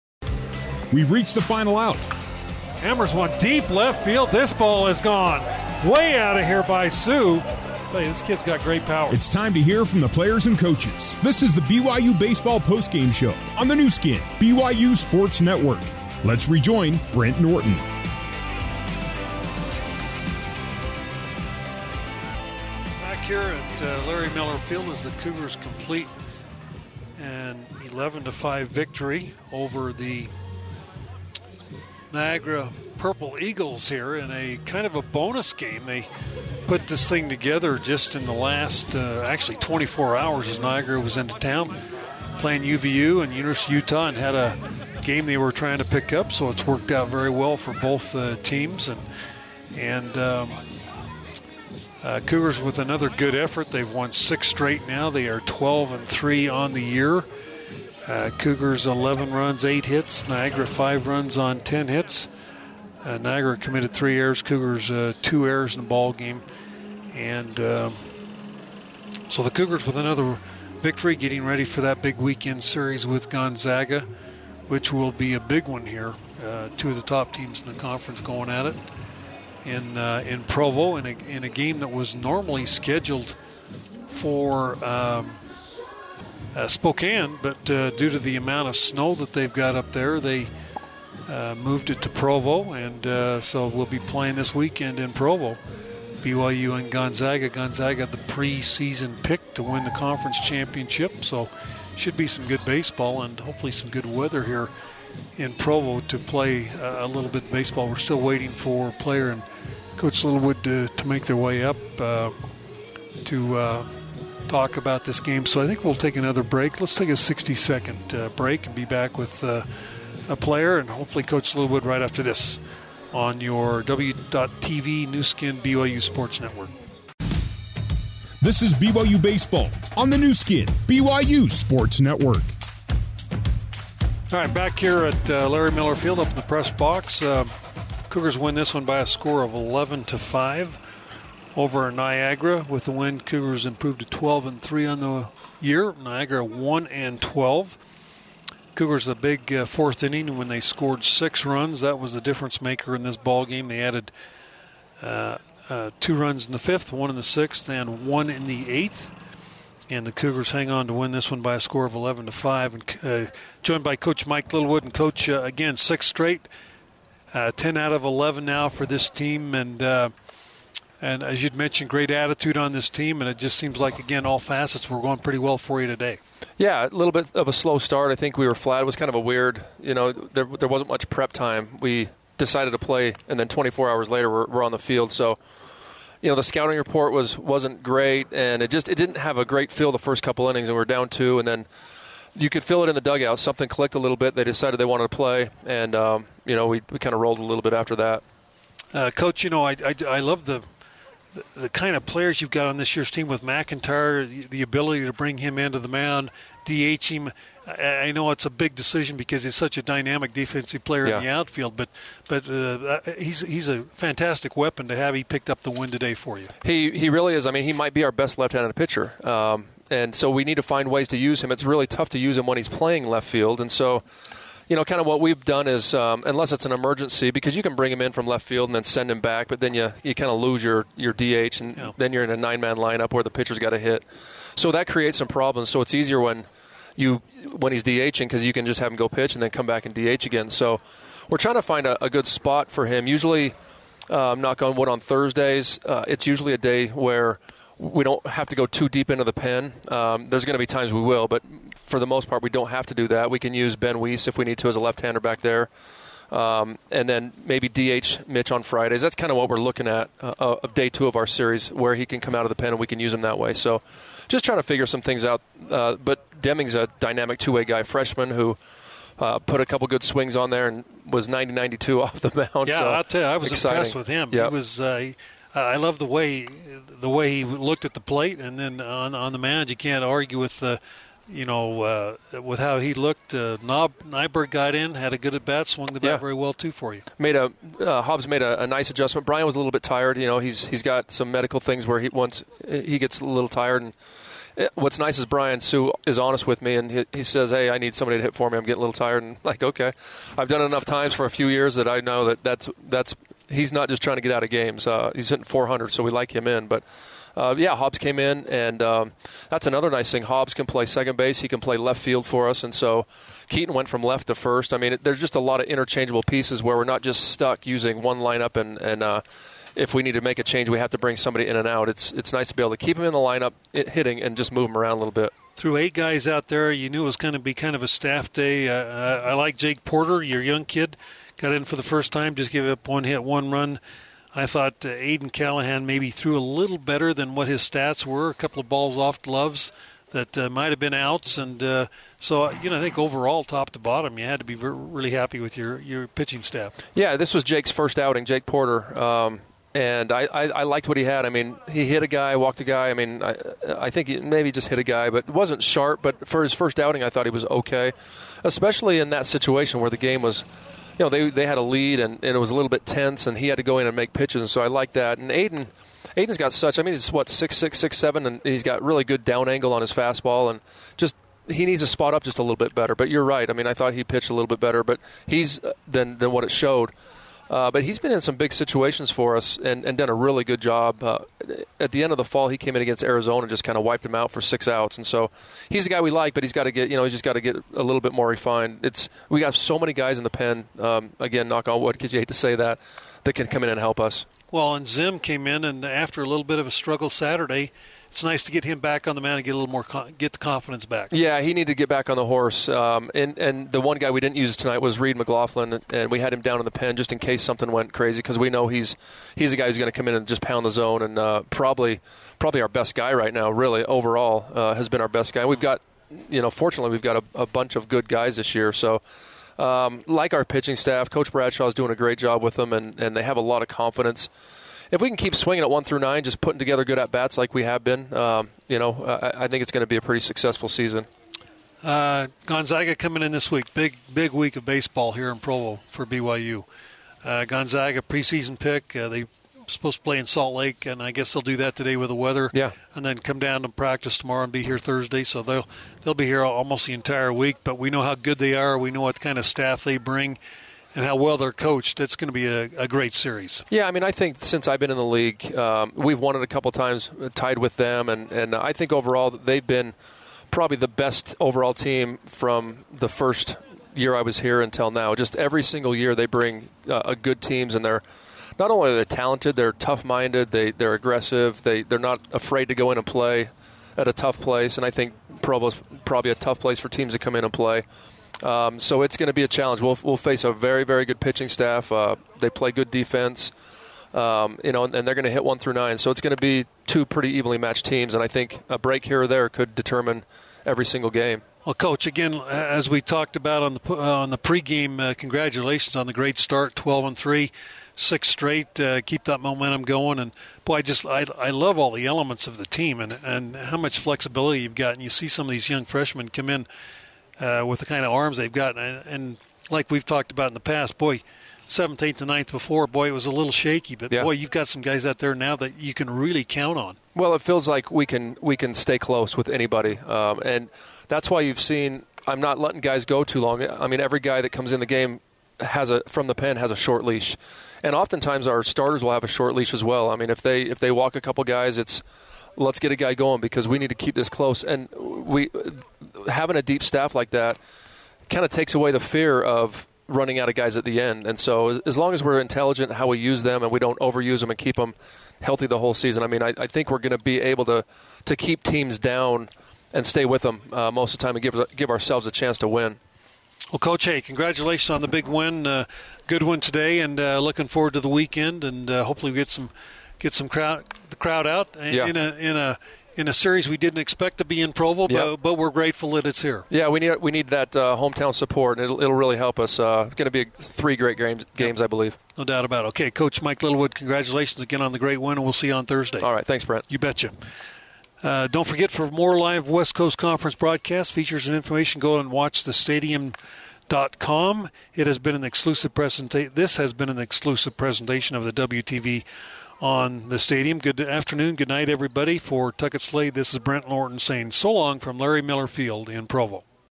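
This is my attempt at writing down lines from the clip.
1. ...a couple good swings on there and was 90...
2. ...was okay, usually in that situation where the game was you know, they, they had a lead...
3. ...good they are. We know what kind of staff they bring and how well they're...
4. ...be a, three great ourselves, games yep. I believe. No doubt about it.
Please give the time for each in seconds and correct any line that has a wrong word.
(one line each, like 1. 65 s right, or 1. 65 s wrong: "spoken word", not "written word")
1. 269 s right
2. 357 s wrong: "especially", not "usually"
3. 448 s right
4. 570 s wrong: "games", not "ourselves".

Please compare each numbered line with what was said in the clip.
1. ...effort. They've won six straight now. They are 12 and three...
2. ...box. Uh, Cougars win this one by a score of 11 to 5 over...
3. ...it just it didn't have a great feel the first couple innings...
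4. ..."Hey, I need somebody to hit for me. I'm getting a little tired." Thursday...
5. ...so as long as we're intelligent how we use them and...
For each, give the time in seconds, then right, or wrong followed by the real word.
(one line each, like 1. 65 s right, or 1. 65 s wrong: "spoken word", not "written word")
1. 53 s right
2. 136 s right
3. 188 s right
4. 297 s wrong: "And", not "Thursday"
5. 541 s right.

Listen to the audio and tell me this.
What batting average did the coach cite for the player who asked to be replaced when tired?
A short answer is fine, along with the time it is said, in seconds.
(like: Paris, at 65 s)
400, at 305 s.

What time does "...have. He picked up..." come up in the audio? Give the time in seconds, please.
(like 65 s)
214 s.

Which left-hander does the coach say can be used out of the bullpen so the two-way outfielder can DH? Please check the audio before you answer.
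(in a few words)
Ben Weiss.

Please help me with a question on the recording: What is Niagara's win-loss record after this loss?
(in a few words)
1 and 12.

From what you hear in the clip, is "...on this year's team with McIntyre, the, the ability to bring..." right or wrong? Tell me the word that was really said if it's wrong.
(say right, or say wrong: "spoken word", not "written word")
right.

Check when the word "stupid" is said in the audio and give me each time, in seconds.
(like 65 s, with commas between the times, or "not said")
not said.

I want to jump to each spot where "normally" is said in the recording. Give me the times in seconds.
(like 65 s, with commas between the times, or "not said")
82 s.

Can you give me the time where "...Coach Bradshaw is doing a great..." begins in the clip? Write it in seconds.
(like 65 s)
421 s.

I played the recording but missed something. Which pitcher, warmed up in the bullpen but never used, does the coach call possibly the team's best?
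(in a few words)
Reed McLaughlin.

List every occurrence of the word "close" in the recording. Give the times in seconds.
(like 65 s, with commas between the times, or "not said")
518 s, 534 s.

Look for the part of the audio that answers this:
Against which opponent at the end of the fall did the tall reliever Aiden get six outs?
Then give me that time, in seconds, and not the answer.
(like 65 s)
383 s.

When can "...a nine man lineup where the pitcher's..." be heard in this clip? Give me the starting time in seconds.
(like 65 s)
232 s.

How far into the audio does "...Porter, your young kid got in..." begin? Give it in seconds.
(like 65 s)
329 s.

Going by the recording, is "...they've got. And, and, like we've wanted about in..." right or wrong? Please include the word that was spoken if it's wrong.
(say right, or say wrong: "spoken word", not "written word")
wrong: "talked", not "wanted".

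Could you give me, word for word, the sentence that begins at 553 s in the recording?
Well, Coach, hey, congratulations on the big win.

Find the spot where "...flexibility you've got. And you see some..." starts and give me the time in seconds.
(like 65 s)
503 s.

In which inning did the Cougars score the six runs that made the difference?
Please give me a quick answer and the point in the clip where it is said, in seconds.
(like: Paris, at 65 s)
fourth, at 149 s.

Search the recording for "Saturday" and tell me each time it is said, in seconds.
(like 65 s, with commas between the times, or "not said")
397 s.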